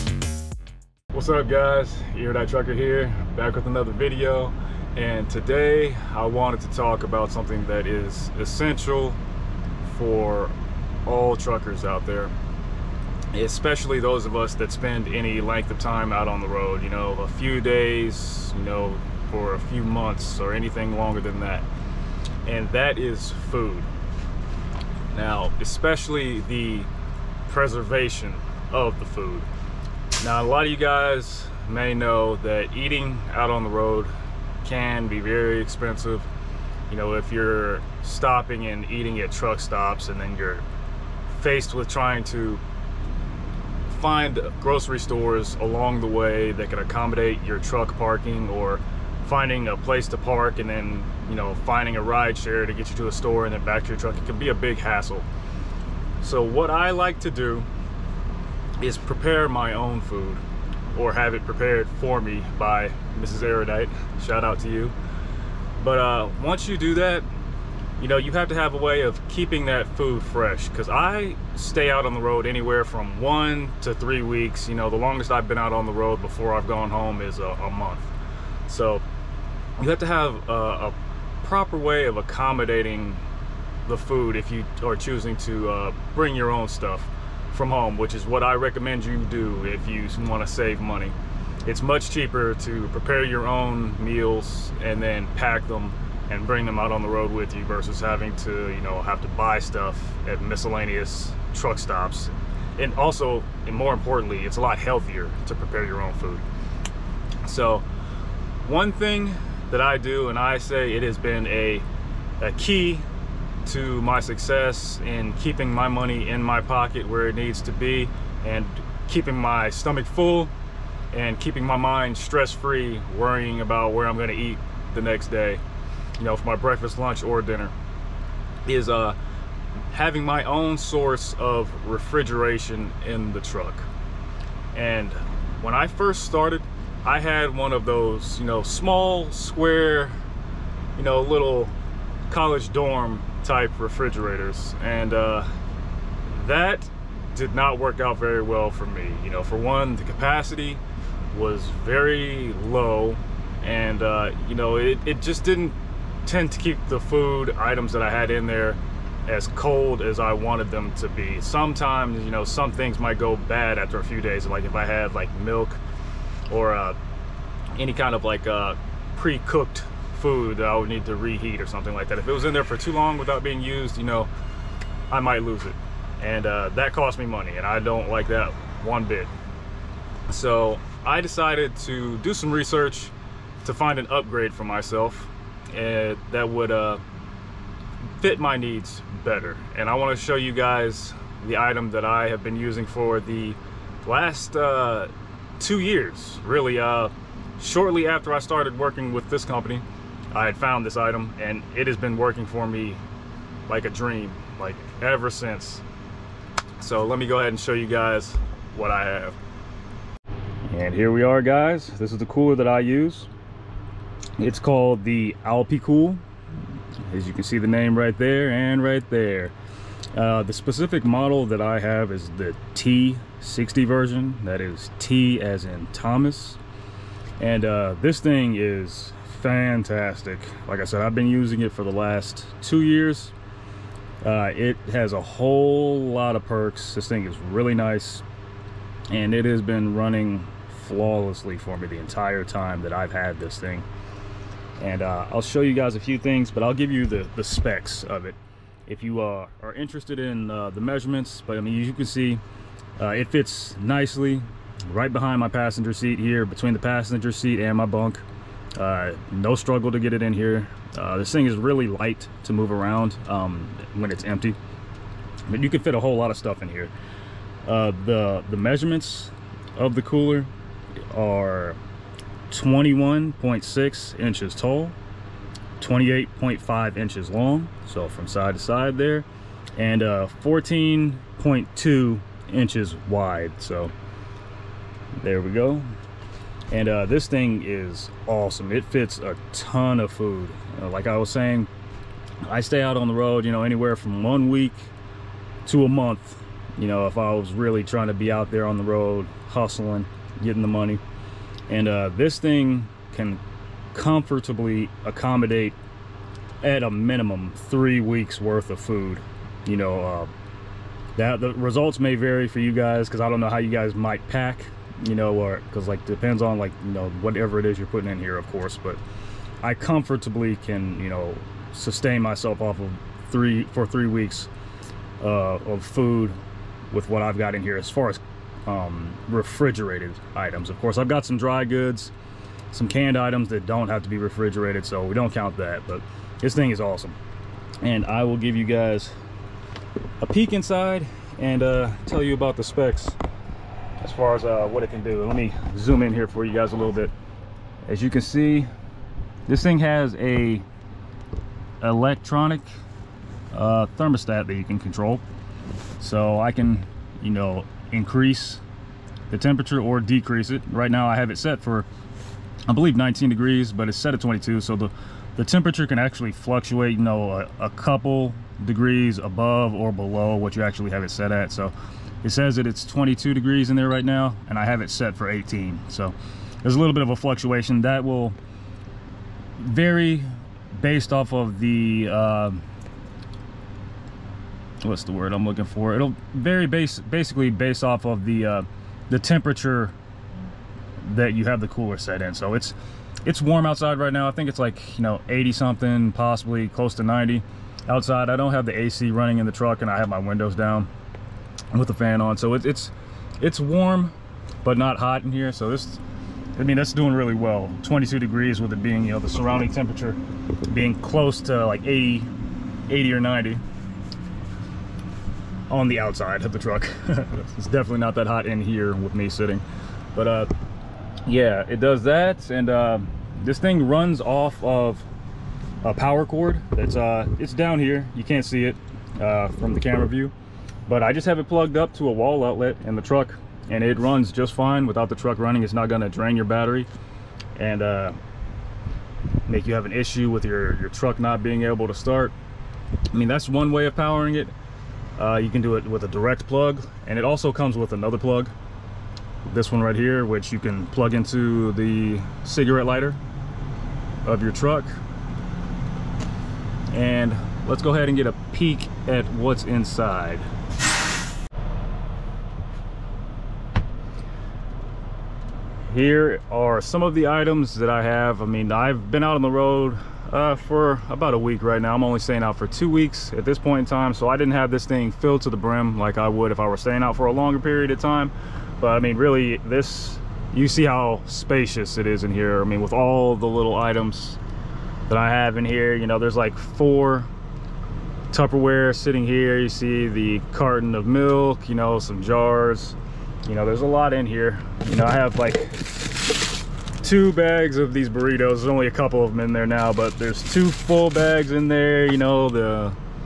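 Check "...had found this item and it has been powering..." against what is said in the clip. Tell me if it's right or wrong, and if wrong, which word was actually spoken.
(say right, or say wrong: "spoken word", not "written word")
wrong: "working", not "powering".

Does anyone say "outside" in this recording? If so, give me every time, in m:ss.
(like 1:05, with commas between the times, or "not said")
6:33, 6:37, 6:55.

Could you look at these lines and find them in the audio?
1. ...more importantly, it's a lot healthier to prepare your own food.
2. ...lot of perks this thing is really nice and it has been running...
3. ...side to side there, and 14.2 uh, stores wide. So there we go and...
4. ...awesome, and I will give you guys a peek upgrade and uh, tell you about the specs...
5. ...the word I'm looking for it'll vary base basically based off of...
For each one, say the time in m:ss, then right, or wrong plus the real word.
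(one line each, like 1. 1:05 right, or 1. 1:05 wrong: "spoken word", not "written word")
1. 1:43 right
2. 3:56 right
3. 4:38 wrong: "inches", not "stores"
4. 5:36 wrong: "inside", not "upgrade"
5. 6:25 right.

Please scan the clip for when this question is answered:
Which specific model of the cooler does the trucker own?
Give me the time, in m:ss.
3:42.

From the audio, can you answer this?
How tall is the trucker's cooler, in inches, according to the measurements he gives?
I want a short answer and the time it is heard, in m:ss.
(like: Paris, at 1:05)
21.6 inches, at 4:32.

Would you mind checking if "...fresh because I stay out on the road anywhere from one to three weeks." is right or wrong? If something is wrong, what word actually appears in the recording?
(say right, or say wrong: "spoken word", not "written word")
right.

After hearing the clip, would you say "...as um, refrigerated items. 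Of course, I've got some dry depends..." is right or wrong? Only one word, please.
wrong.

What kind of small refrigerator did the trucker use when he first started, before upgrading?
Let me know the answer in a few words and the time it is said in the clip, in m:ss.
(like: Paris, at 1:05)
college dorm type, at 2:22.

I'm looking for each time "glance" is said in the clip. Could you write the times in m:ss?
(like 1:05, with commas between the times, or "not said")
not said.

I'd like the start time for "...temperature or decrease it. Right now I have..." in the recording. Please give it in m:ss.
5:59.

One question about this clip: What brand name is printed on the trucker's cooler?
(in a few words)
Alpicool.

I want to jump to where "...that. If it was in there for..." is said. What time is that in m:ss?
2:52.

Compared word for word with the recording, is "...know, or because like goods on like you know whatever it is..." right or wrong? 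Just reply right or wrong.
wrong.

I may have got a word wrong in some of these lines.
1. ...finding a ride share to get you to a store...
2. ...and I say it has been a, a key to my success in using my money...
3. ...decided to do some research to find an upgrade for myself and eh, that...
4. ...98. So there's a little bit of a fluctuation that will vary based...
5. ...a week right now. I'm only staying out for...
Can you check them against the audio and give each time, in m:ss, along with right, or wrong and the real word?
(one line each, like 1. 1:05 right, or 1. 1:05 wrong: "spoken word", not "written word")
1. 0:51 right
2. 1:50 wrong: "keeping", not "using"
3. 3:01 right
4. 6:15 wrong: "18", not "98"
5. 7:51 right.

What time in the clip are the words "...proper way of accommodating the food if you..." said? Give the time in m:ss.
1:21.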